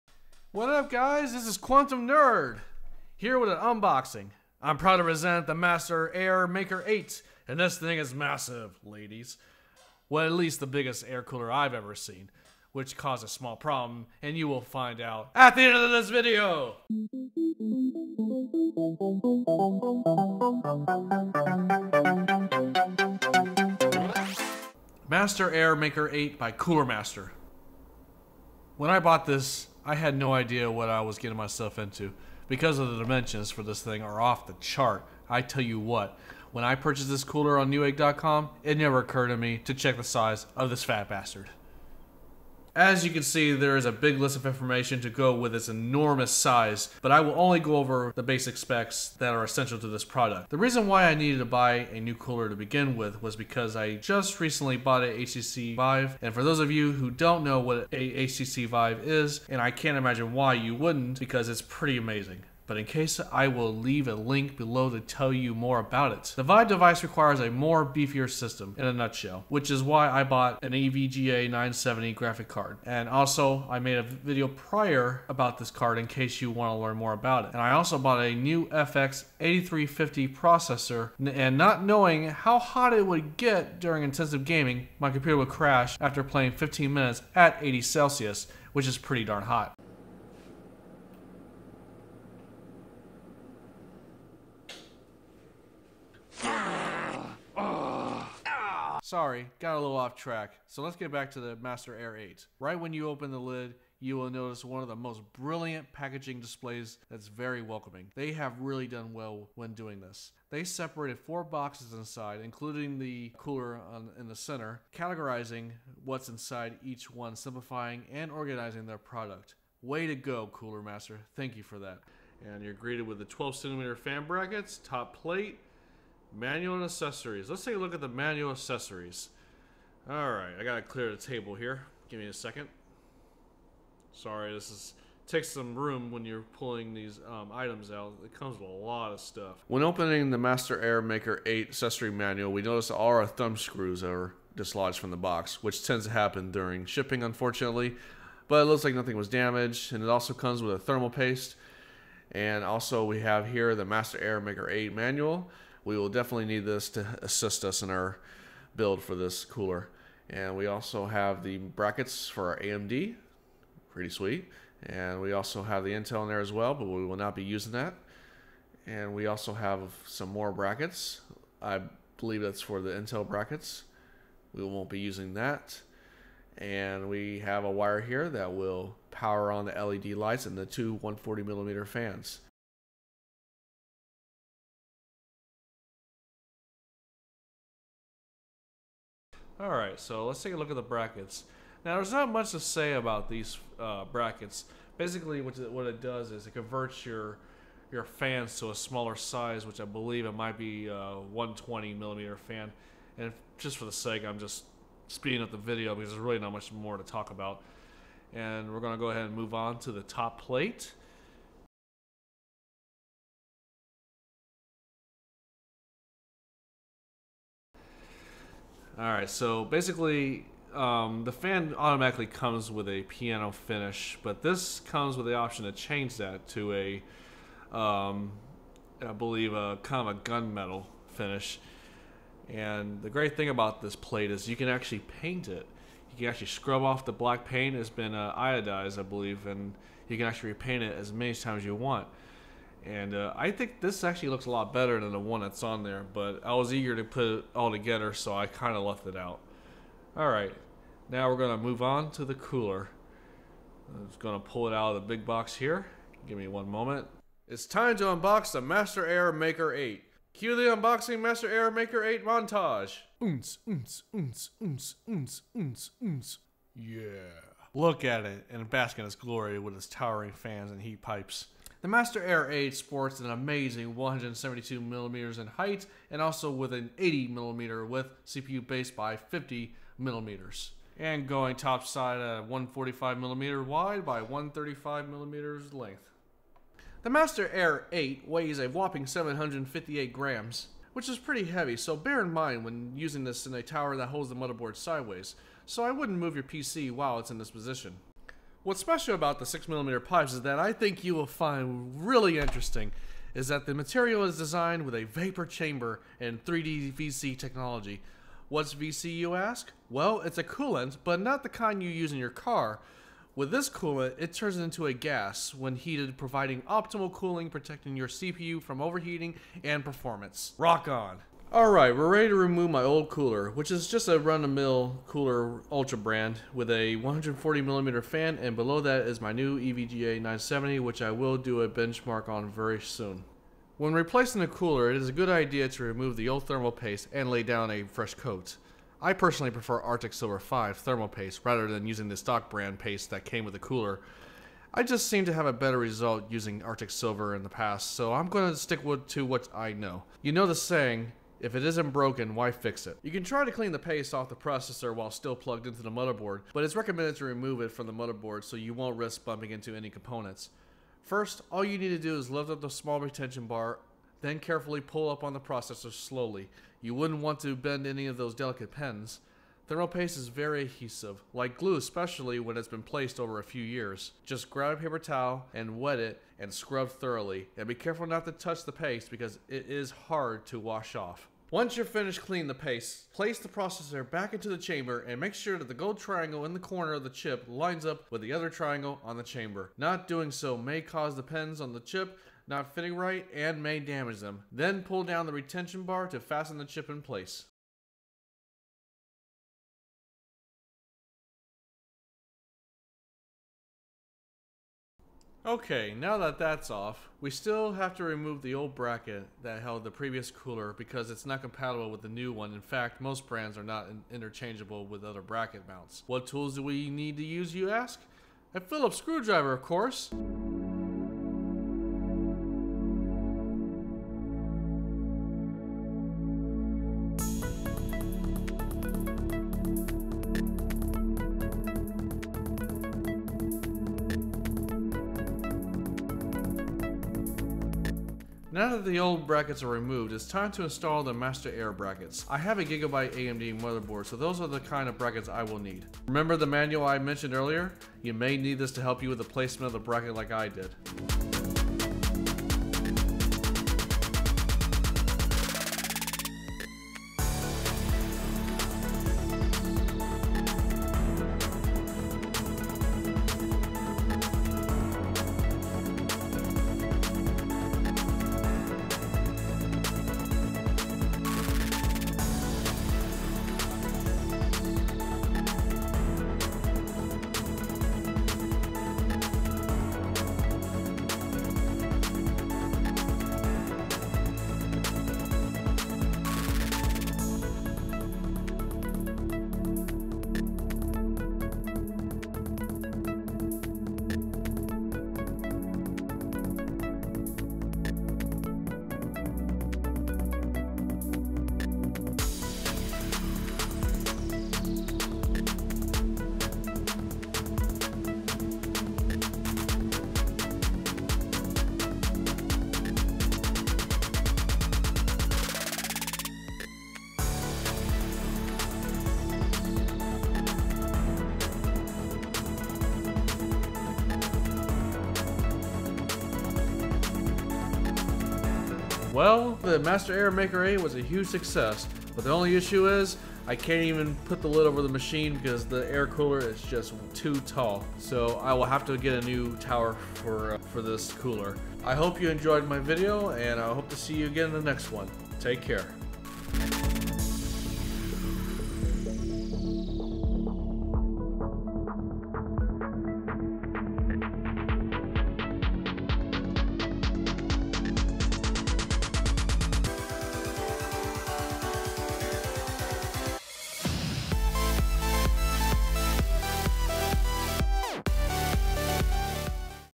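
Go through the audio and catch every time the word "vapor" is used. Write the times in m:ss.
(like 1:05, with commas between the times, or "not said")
5:05.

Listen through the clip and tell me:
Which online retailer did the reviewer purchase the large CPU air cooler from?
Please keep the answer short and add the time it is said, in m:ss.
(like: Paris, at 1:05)
newegg.com, at 0:37.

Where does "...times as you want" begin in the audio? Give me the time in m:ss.
4:01.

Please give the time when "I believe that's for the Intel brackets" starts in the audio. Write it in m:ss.
2:51.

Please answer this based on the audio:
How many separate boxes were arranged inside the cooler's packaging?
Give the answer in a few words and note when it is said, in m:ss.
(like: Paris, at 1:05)
4, at 1:51.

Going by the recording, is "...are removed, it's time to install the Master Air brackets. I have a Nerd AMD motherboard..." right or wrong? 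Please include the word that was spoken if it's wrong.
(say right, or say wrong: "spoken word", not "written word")
wrong: "Gigabyte", not "Nerd".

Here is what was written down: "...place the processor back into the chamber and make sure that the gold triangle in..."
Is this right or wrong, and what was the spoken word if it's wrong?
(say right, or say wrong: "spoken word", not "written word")
right.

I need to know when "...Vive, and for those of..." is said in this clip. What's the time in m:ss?
0:55.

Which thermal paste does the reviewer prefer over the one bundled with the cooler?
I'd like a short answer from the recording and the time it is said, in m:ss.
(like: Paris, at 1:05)
Arctic Silver 5, at 5:39.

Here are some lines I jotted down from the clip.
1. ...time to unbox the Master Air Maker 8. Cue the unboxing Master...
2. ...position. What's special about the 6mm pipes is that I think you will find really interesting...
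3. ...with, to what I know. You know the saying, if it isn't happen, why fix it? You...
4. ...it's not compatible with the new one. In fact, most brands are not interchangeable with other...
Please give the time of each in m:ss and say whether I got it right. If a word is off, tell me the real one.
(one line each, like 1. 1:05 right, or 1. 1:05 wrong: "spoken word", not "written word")
1. 4:17 right
2. 4:57 right
3. 5:48 wrong: "broken", not "happen"
4. 6:51 right.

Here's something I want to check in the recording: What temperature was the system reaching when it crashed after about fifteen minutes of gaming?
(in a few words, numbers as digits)
80 Celsius.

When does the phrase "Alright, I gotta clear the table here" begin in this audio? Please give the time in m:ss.
2:10.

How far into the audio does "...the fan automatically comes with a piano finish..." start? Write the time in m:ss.
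3:41.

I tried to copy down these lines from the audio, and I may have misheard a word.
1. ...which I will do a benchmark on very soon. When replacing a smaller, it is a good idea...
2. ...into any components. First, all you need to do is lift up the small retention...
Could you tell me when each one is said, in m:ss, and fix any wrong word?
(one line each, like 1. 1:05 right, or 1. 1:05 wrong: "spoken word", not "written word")
1. 5:30 wrong: "cooler", not "smaller"
2. 5:59 right.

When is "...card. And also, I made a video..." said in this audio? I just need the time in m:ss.
1:12.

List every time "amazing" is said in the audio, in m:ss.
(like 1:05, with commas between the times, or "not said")
1:01, 4:33.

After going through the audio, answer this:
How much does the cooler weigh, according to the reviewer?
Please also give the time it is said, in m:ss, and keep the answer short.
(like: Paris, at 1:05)
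758 grams, at 4:49.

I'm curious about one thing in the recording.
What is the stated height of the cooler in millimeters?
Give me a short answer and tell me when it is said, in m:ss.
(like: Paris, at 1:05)
172 millimeters, at 4:33.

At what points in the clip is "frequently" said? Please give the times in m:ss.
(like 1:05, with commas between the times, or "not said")
not said.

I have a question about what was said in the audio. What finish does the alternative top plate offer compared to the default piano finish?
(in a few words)
gunmetal.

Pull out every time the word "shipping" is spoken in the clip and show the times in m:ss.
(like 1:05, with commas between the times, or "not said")
2:26.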